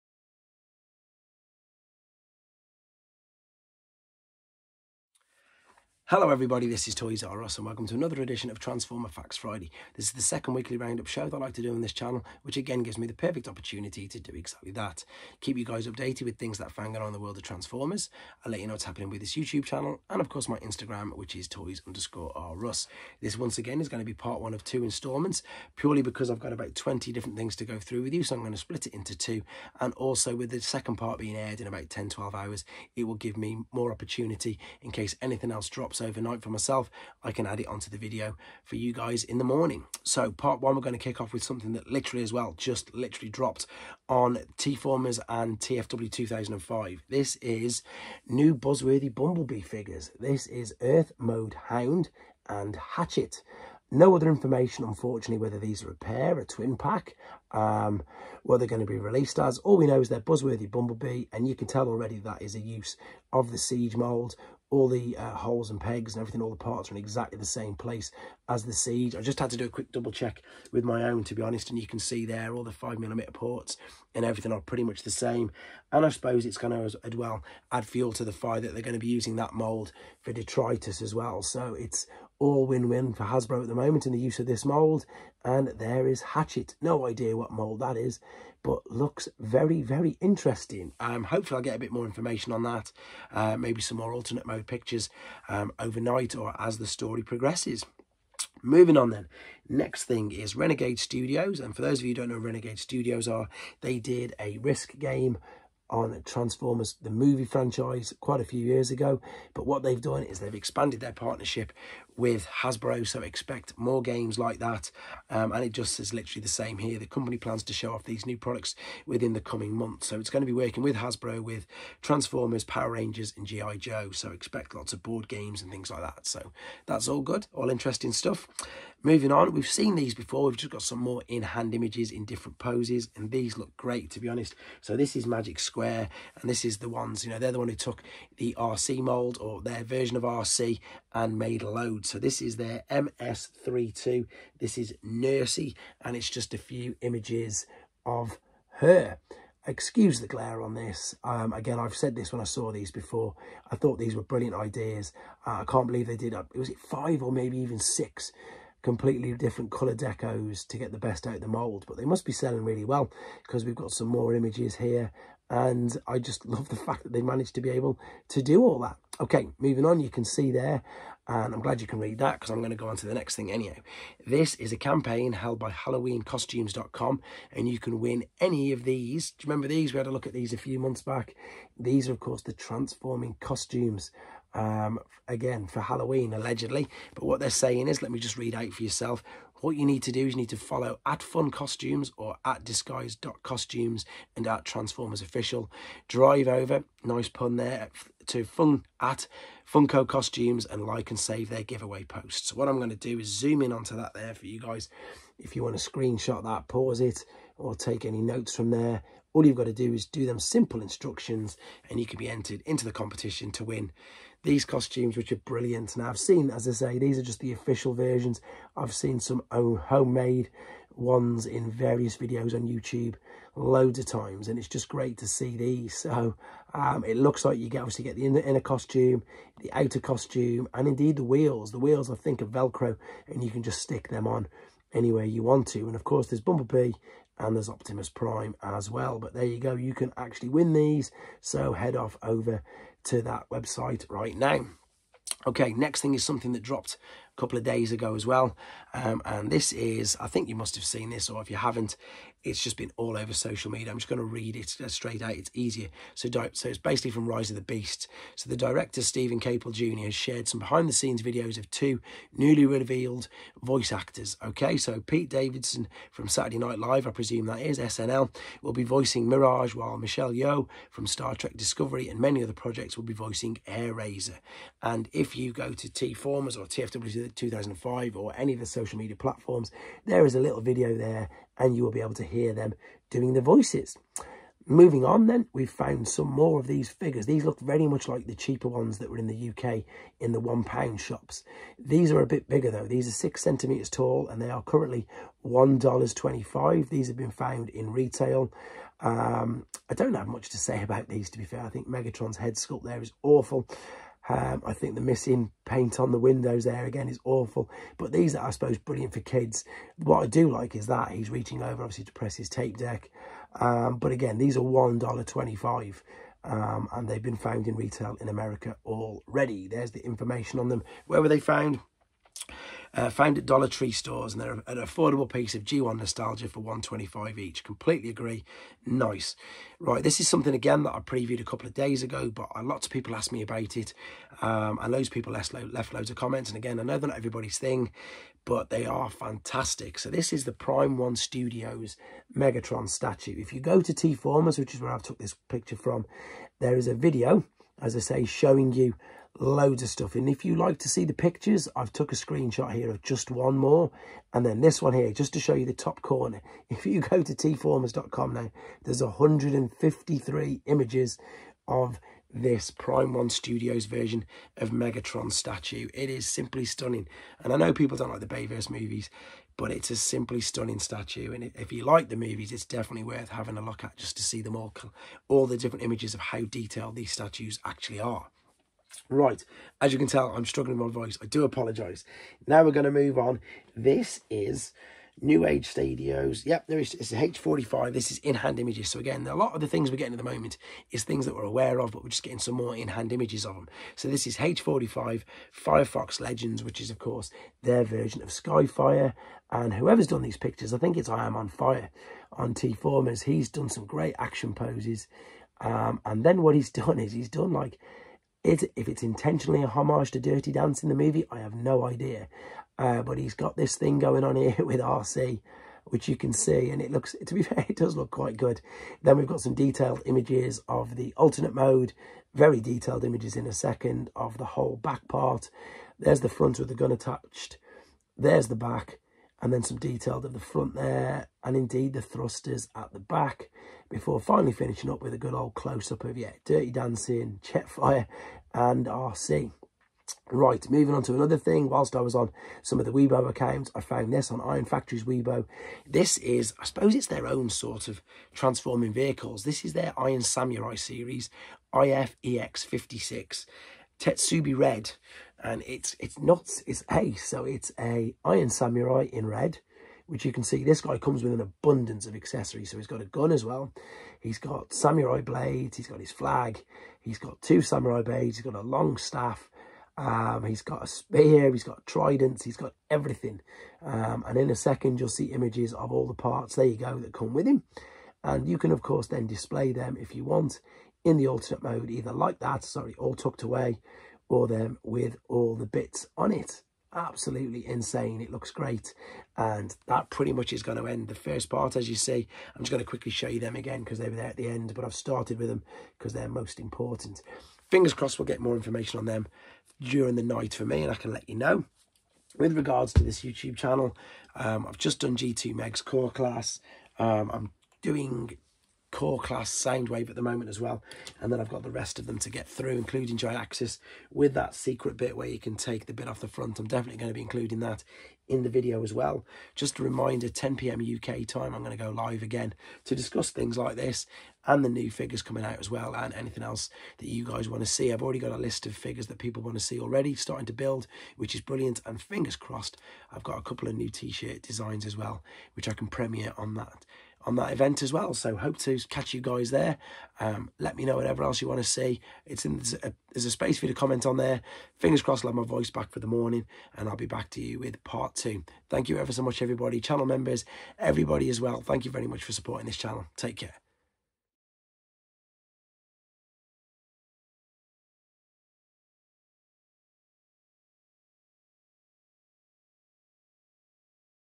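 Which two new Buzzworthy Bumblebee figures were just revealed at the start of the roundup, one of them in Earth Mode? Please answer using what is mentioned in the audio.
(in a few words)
Hound and Hatchet.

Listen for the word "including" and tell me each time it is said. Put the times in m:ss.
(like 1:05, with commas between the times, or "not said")
8:32, 8:37.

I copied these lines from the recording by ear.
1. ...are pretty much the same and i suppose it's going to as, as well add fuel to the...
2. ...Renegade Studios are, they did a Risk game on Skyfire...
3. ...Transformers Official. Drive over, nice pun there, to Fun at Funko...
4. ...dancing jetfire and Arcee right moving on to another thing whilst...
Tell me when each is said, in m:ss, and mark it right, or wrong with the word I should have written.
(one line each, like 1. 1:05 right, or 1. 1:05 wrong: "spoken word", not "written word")
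1. 1:14 right
2. 1:42 wrong: "Transformers", not "Skyfire"
3. 3:14 right
4. 7:16 right.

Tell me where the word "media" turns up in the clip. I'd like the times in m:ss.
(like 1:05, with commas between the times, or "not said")
4:13, 4:38.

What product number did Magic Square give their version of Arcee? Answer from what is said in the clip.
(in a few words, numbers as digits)
MS32.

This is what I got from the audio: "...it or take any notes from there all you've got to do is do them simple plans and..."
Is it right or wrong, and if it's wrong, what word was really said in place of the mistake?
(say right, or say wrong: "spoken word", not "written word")
wrong: "instructions", not "plans".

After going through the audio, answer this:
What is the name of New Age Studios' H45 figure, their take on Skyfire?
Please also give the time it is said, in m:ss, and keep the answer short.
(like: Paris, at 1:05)
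Firefox, at 6:35.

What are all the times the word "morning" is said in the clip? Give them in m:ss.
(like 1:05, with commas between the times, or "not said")
0:39, 9:06.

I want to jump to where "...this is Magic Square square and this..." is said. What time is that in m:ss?
2:14.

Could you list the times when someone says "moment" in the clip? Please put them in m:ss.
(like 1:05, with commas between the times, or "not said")
1:23, 6:30, 8:30.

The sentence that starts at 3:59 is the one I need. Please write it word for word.
But there you go, you can actually win these.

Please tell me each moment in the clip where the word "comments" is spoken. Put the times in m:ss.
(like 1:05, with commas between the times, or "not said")
5:36, 9:03.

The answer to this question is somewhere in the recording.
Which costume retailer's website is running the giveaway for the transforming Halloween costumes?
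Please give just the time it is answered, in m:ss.
2:55.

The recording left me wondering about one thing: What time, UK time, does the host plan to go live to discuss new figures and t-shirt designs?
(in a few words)
10 p.m.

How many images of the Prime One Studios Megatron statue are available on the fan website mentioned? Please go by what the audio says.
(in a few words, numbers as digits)
153.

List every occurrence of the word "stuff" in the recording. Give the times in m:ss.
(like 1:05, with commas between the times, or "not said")
2:08, 5:49.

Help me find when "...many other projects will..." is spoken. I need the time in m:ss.
4:32.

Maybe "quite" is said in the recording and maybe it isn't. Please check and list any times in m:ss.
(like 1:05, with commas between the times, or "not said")
1:48, 6:58.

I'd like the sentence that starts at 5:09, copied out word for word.
What I do like is that he's reaching over, obviously, to press his tape deck.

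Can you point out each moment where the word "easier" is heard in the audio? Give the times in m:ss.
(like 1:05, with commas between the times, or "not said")
4:15.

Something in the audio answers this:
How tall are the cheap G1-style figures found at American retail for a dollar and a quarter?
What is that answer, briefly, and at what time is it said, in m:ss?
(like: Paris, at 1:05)
6 centimetres, at 4:53.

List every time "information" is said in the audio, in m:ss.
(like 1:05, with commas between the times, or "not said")
0:54, 1:32, 5:20, 8:18.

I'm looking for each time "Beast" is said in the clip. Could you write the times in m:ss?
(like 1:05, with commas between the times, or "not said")
4:17.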